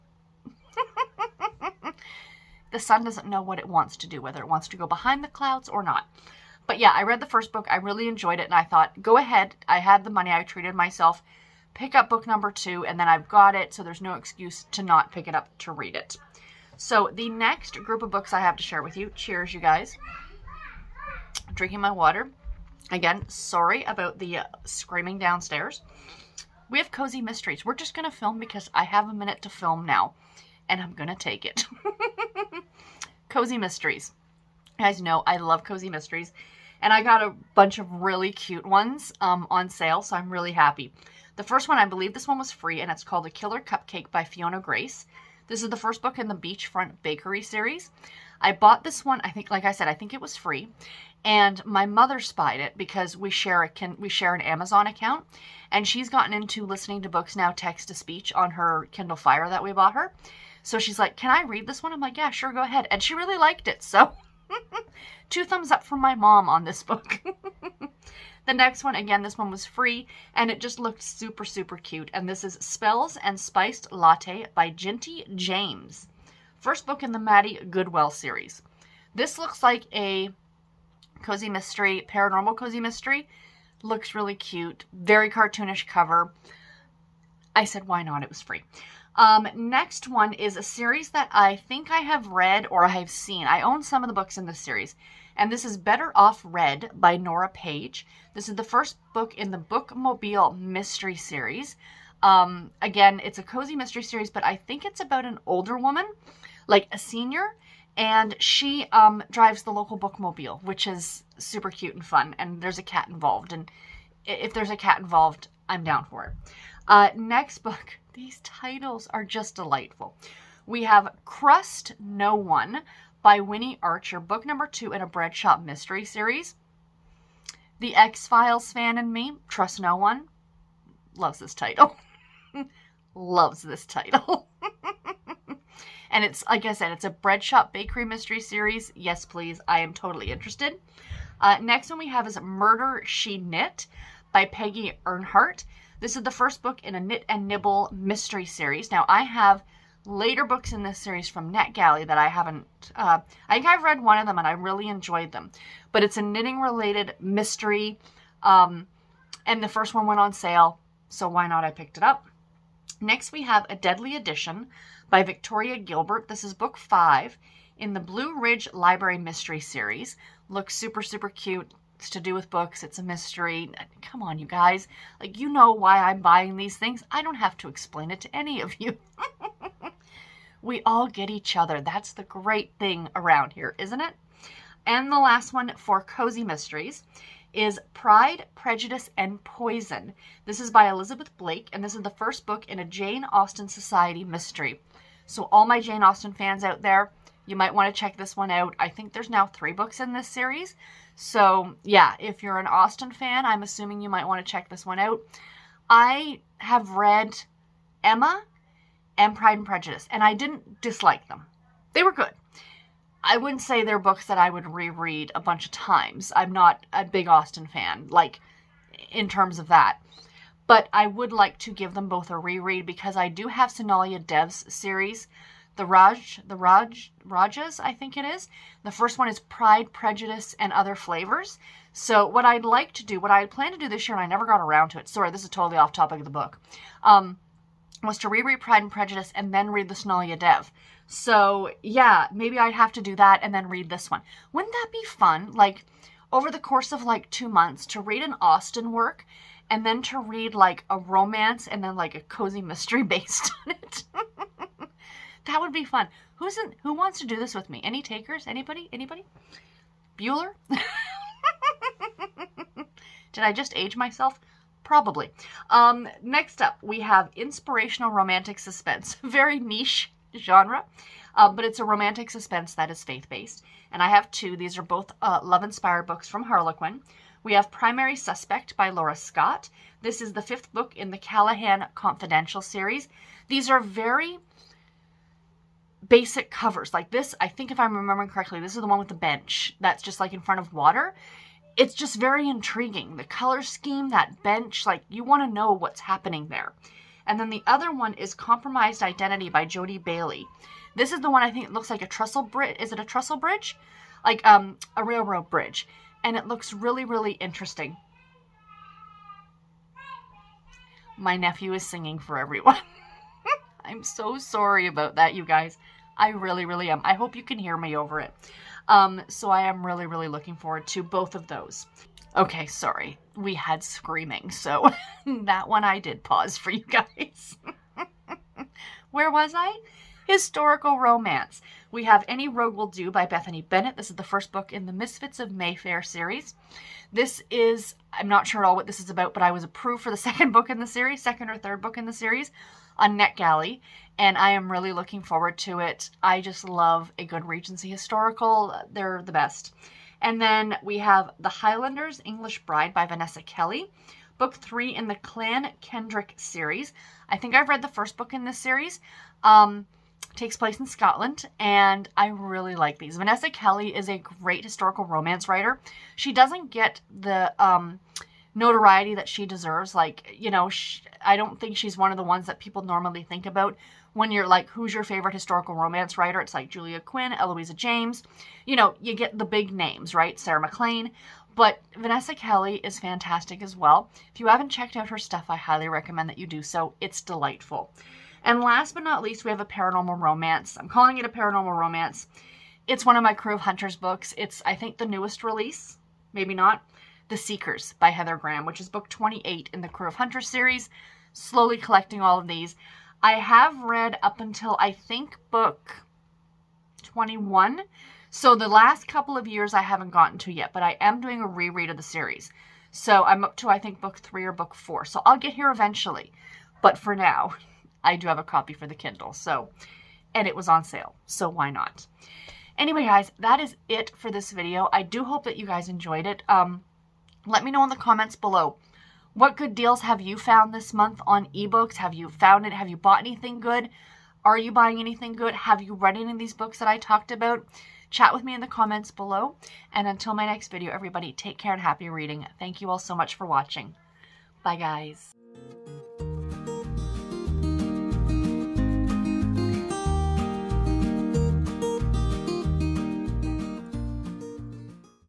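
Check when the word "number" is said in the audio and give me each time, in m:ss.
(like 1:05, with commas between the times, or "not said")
0:12, 2:04.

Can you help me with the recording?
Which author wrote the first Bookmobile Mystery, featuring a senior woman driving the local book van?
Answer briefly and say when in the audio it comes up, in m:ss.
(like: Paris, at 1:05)
Nora Page, at 1:37.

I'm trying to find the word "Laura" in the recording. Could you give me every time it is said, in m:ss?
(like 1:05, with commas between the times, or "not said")
4:38.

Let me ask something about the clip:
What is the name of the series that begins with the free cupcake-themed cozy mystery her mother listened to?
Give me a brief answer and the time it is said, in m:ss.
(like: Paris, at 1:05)
Beachfront Bakery, at 0:46.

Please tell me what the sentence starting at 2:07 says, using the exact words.
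The X Files fan in me, Trust No One, loves this title.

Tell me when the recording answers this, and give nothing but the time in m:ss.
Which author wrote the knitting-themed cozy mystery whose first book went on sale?
2:24.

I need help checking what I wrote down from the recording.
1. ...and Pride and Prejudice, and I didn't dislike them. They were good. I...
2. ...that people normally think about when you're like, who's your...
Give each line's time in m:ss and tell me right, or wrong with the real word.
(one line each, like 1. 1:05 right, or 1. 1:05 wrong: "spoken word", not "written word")
1. 3:29 right
2. 6:12 right.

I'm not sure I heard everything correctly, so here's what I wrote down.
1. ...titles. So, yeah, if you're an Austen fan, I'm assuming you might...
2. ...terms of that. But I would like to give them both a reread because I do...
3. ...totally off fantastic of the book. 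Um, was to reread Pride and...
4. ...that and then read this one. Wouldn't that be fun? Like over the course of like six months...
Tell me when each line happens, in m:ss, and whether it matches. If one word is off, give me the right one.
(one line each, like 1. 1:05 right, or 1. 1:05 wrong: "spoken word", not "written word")
1. 3:20 wrong: "series", not "titles"
2. 3:39 right
3. 3:55 wrong: "topic", not "fantastic"
4. 4:03 wrong: "two", not "six".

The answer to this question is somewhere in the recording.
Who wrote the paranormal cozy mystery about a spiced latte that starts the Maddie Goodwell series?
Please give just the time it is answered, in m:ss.
1:14.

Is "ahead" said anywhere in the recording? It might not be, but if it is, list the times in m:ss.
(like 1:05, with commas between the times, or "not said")
0:09, 1:02.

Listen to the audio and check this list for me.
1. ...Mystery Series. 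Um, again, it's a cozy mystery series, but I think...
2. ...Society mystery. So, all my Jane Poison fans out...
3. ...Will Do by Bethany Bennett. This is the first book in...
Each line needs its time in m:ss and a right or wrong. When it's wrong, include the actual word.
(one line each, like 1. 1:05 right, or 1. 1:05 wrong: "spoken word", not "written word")
1. 1:40 right
2. 3:13 wrong: "Austen", not "Poison"
3. 5:32 right.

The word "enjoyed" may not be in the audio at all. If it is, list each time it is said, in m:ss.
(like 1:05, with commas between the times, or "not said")
0:08, 2:34, 7:05.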